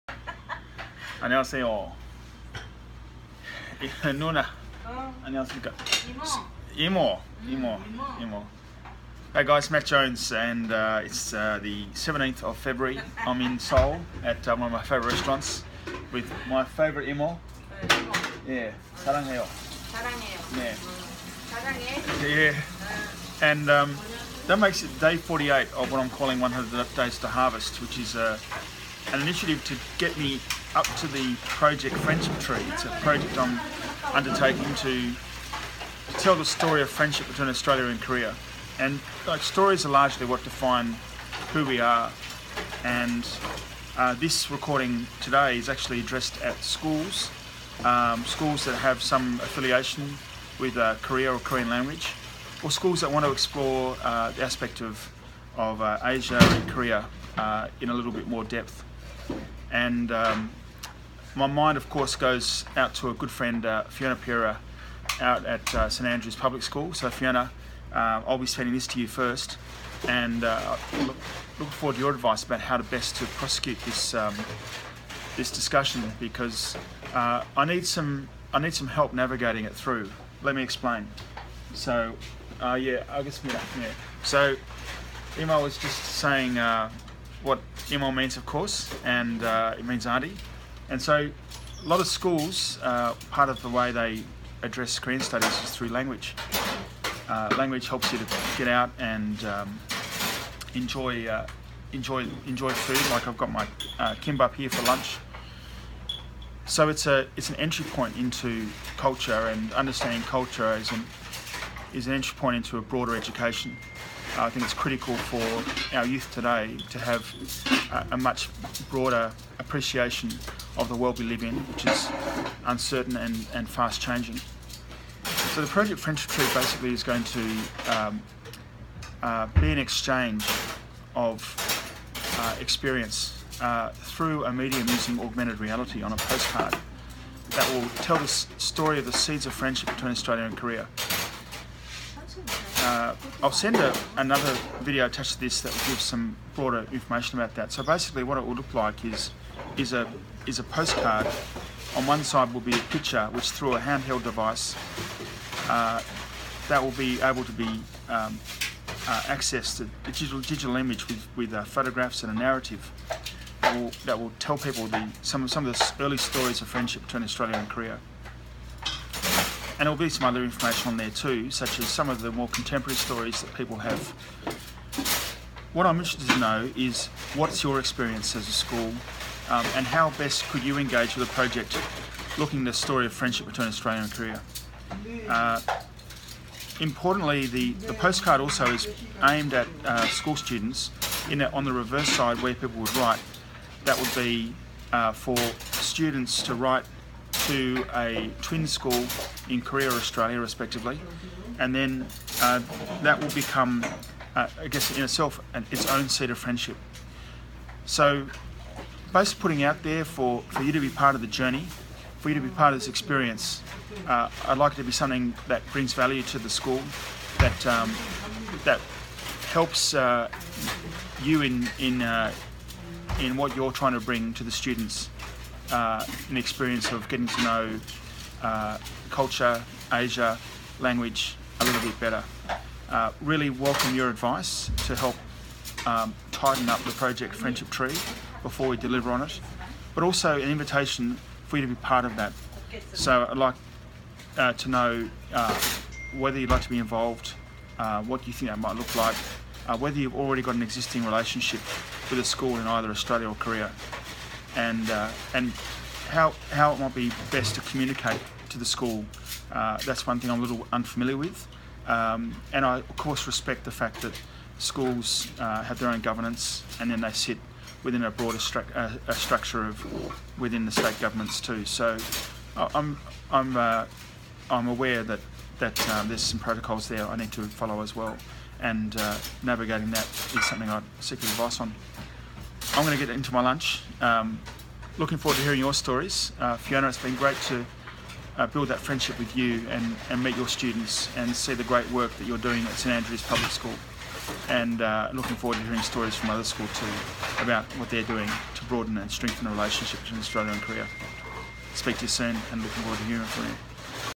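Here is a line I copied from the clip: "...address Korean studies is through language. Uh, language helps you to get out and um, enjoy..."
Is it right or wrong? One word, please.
right.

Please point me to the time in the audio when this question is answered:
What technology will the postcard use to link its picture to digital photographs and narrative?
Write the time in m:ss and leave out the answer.
2:15.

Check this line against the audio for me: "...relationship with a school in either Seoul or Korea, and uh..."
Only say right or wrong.
wrong.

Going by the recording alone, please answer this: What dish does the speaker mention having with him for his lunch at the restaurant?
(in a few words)
kimbap.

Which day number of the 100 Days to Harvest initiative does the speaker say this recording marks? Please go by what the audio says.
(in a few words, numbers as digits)
48.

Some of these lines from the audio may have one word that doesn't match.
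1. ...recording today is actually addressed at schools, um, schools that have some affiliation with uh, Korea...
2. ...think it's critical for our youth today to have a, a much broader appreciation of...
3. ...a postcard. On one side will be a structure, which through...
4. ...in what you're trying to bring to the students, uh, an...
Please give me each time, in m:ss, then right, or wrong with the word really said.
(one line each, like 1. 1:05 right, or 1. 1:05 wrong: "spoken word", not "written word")
1. 0:44 right
2. 1:54 right
3. 2:30 wrong: "picture", not "structure"
4. 3:43 right.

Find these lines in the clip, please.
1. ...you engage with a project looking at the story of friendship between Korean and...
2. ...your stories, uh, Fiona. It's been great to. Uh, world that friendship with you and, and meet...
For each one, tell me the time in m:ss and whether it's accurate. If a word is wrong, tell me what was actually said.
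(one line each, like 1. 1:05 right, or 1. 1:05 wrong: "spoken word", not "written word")
1. 3:00 wrong: "Australia", not "Korean"
2. 4:45 wrong: "build", not "world".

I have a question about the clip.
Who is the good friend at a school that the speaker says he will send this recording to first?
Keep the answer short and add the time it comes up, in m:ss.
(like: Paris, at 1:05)
Fiona Pira, at 1:03.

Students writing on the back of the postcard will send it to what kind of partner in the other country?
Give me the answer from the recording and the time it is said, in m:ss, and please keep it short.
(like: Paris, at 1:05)
twin school, at 3:18.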